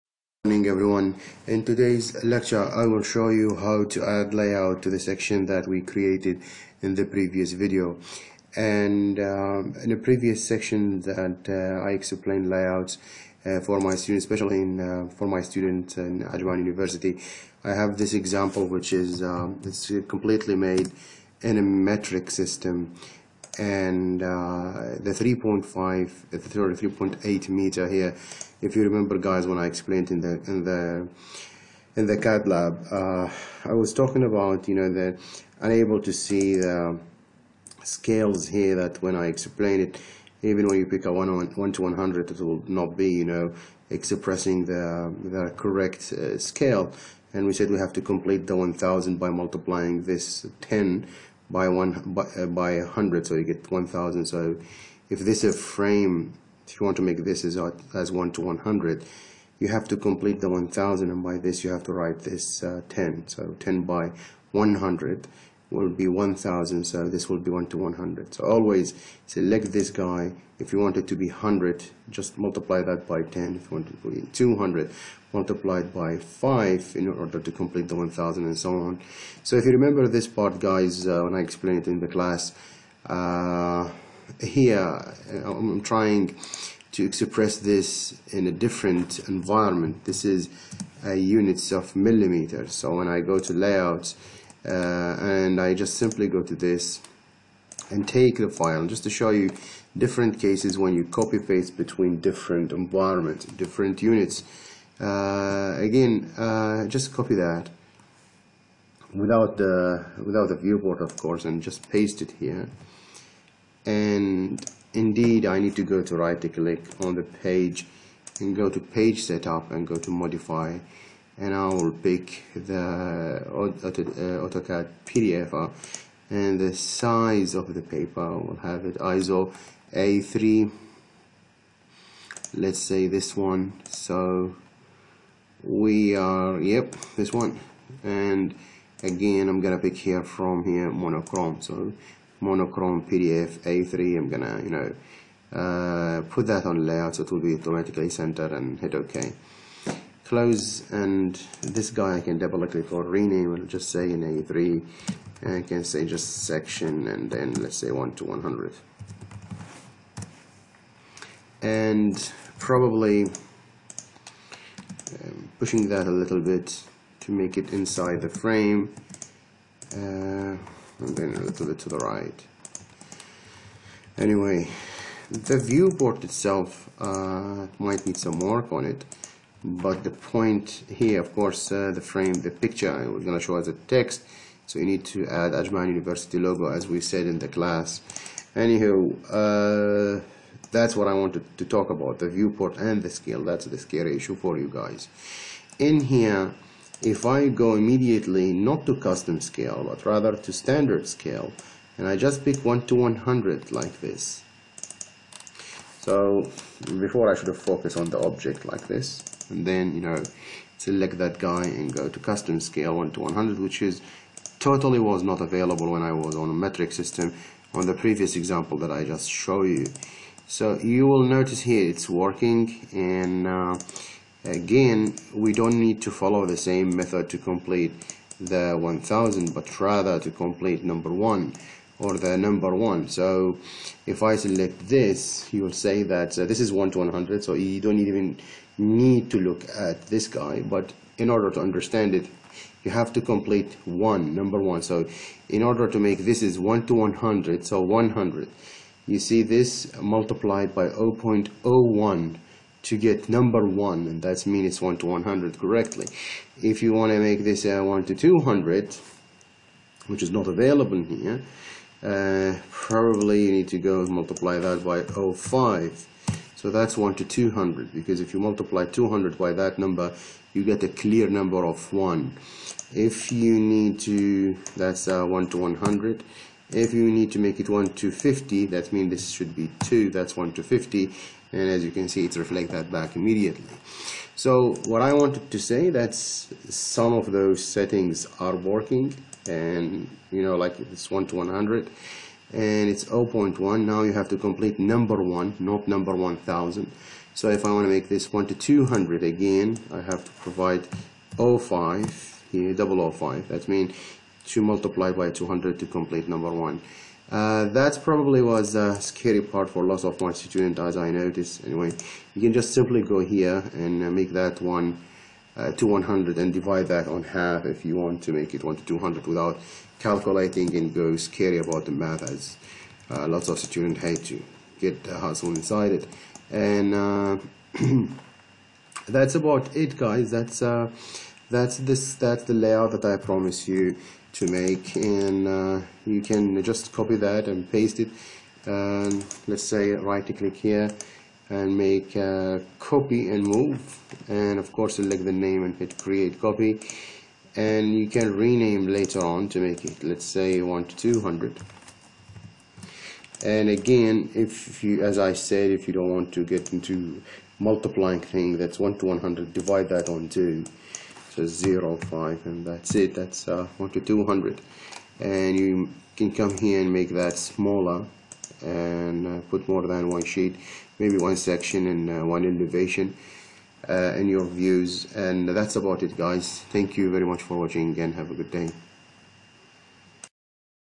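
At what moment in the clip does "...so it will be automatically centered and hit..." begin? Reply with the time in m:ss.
2:27.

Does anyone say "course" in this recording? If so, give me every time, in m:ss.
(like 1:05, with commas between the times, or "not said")
1:51, 3:01, 5:44.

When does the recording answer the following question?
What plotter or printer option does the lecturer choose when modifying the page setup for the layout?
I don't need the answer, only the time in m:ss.
2:03.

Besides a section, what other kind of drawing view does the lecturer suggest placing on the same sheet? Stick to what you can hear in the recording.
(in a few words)
elevation.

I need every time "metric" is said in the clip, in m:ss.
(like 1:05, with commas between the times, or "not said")
0:21, 3:36.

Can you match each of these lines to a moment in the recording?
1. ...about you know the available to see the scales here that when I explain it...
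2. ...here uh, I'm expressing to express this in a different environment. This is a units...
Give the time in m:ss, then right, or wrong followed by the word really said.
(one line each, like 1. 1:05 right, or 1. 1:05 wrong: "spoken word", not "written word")
1. 0:34 wrong: "unable", not "available"
2. 1:24 wrong: "trying", not "expressing".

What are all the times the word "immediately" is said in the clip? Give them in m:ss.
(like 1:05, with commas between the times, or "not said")
3:17, 4:43.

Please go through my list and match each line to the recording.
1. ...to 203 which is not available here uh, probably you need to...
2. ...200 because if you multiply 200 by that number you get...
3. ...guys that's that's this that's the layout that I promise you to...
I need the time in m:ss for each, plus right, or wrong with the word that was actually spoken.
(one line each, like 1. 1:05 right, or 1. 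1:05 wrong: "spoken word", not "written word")
1. 4:18 wrong: "200", not "203"
2. 4:27 right
3. 5:29 right.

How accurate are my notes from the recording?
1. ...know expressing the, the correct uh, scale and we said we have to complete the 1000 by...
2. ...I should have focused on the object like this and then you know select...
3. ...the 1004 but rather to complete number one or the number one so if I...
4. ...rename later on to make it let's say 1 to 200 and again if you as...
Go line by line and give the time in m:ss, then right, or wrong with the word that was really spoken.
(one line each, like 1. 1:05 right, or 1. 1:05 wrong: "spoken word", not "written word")
1. 0:43 right
2. 3:27 right
3. 3:48 wrong: "1000", not "1004"
4. 5:48 right.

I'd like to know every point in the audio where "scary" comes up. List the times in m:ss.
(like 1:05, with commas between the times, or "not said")
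3:13, 5:08, 5:21.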